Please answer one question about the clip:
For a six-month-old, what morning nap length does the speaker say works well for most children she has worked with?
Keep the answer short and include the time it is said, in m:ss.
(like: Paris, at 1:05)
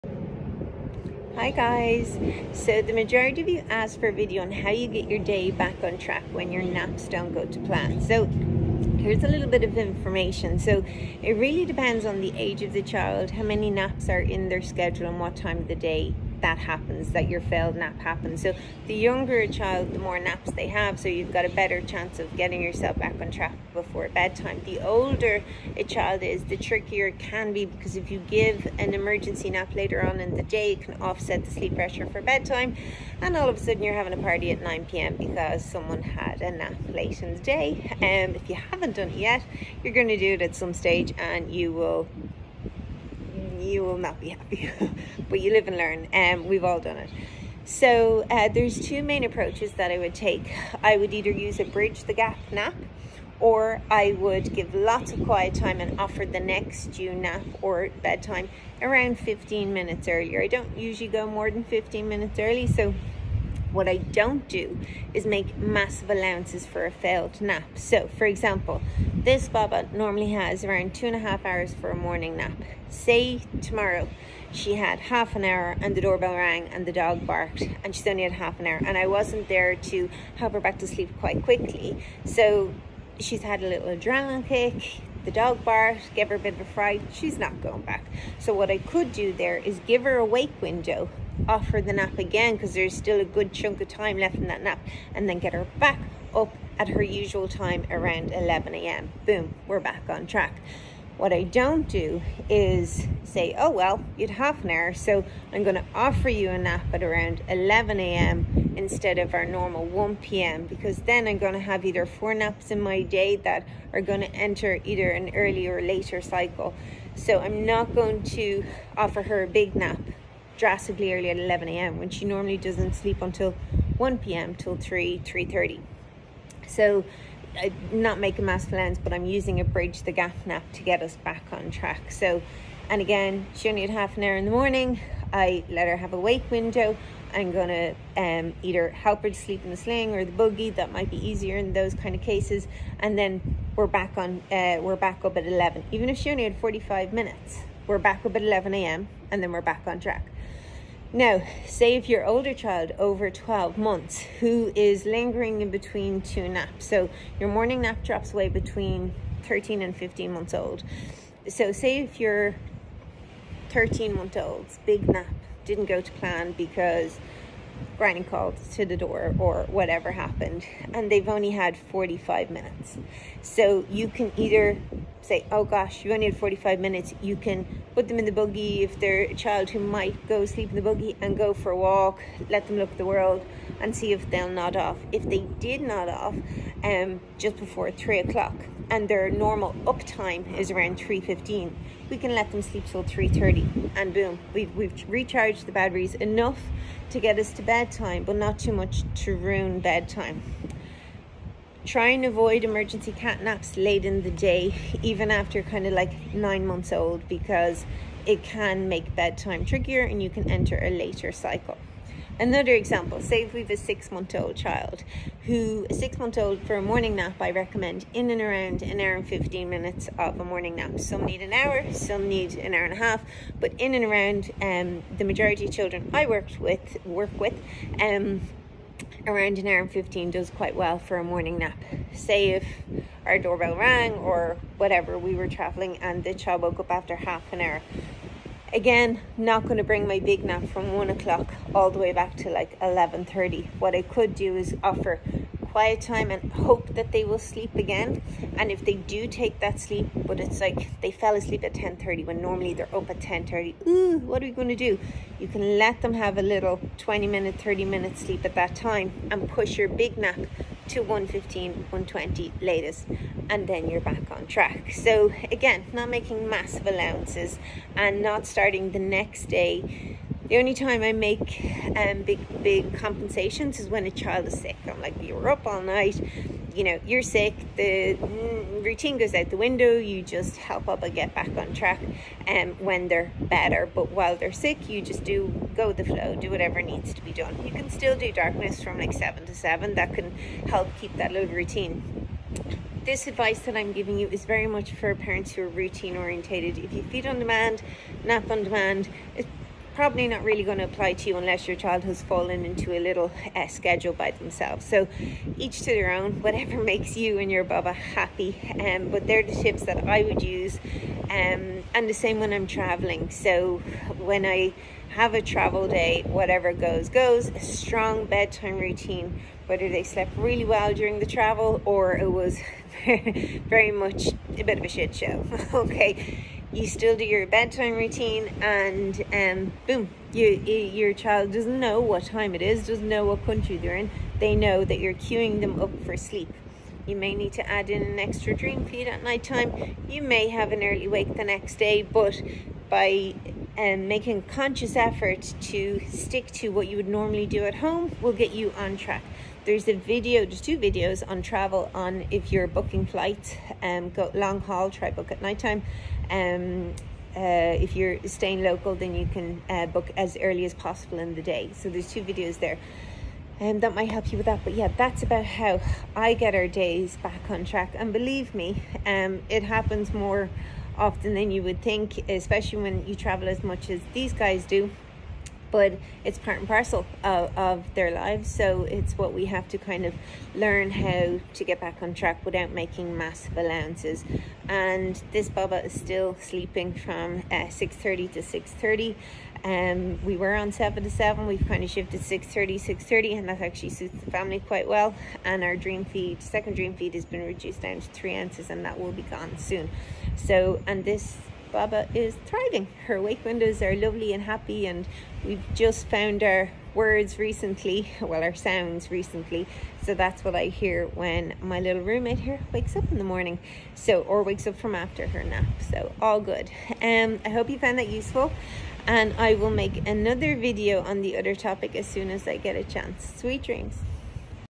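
an hour and 15 minutes, at 3:38.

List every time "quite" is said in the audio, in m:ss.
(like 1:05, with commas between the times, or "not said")
1:21, 3:50, 6:34.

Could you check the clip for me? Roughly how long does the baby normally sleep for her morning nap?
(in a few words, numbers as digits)
two and a half hours.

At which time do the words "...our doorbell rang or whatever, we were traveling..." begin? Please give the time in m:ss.
3:53.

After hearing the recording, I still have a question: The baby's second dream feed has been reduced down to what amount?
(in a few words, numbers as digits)
3 ounces.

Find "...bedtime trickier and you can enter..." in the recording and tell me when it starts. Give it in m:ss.
3:29.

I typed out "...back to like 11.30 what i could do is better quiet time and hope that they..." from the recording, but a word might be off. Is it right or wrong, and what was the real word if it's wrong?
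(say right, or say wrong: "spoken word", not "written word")
wrong: "offer", not "better".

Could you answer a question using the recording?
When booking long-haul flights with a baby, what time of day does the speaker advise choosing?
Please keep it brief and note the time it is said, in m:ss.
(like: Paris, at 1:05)
nighttime, at 5:55.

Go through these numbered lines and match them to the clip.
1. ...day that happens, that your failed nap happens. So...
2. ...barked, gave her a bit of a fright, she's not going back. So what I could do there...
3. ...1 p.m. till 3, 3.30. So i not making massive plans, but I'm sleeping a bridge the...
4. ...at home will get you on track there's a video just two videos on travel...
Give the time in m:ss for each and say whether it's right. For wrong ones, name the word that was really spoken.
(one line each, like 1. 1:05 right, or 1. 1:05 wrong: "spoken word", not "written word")
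1. 0:15 right
2. 1:25 right
3. 2:03 wrong: "using", not "sleeping"
4. 5:47 right.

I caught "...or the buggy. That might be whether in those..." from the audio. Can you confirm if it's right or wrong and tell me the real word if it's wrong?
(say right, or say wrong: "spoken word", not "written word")
wrong: "easier", not "whether".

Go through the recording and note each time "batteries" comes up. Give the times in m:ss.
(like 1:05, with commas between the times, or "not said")
3:15.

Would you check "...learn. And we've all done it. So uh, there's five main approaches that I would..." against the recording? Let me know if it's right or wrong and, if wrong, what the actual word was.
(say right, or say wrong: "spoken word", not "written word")
wrong: "two", not "five".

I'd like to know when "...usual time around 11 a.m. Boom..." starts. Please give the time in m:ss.
1:37.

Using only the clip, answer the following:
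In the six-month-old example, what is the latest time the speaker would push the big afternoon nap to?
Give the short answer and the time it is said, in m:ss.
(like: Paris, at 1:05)
1:20, at 4:21.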